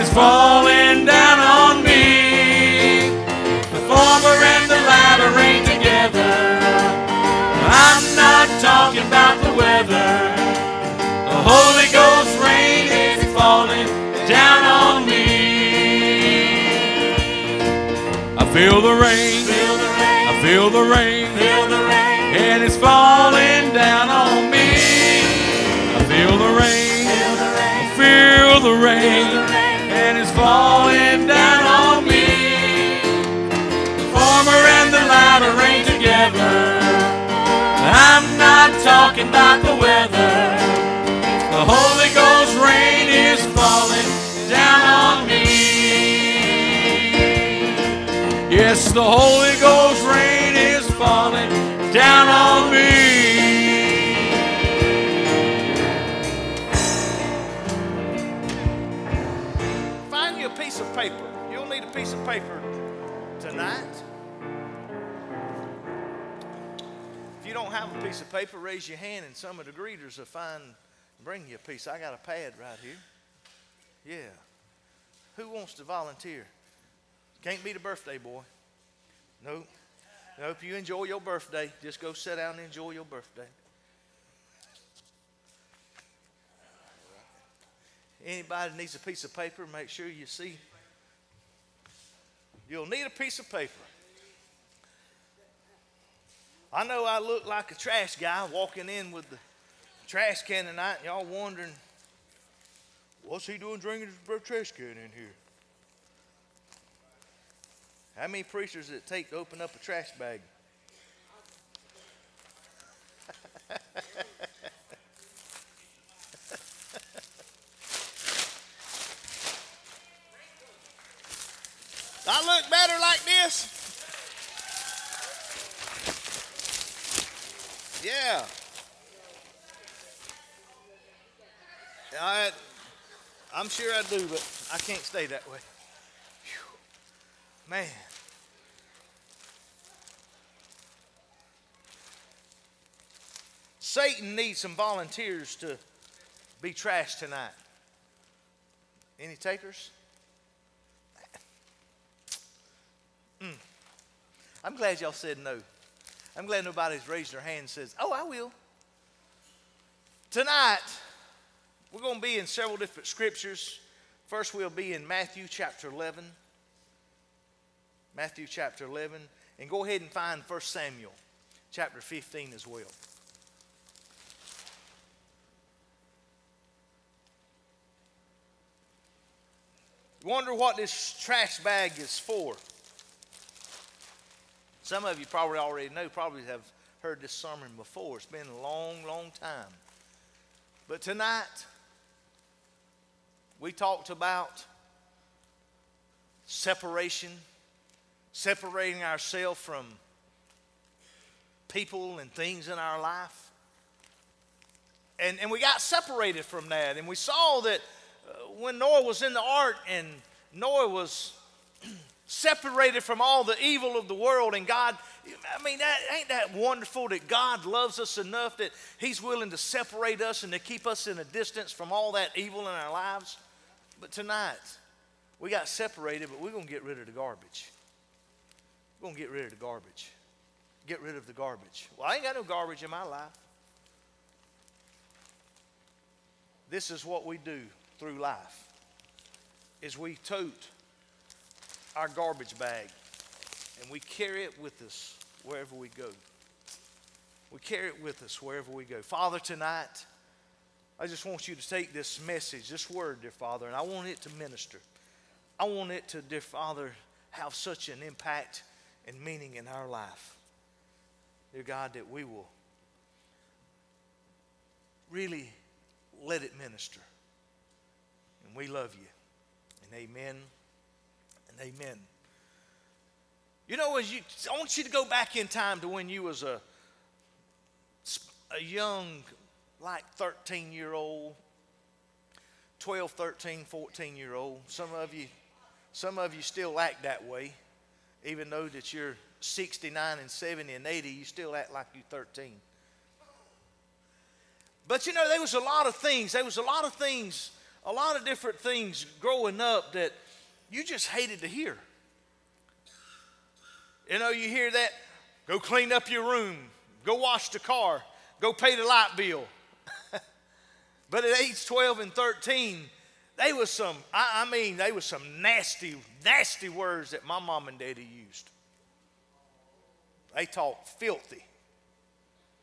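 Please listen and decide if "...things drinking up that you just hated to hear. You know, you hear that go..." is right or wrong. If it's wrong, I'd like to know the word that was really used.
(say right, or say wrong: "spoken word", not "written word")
wrong: "growing", not "drinking".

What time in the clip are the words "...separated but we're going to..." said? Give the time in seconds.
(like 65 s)
225 s.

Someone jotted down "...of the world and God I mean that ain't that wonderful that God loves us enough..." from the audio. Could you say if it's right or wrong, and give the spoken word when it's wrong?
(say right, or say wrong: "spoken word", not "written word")
right.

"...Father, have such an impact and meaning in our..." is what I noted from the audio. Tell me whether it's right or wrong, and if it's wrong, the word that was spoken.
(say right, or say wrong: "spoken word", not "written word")
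right.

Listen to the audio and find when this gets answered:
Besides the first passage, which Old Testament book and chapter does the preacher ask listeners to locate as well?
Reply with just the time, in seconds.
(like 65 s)
170 s.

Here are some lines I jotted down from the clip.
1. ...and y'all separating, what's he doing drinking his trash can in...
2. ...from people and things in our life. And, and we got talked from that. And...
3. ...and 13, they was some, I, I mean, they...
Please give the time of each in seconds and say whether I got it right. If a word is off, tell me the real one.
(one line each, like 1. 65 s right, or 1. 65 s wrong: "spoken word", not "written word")
1. 100 s wrong: "wondering", not "separating"
2. 199 s wrong: "separated", not "talked"
3. 311 s right.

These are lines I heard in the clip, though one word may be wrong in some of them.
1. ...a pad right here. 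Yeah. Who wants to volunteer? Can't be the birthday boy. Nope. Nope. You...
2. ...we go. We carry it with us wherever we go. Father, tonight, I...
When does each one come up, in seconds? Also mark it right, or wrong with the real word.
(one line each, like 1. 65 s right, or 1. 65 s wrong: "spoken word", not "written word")
1. 72 s right
2. 245 s right.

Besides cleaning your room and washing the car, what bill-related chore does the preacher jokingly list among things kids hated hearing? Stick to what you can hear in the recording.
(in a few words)
Pay the light bill.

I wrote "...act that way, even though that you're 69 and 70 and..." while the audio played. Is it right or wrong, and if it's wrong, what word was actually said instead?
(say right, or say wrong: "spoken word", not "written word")
right.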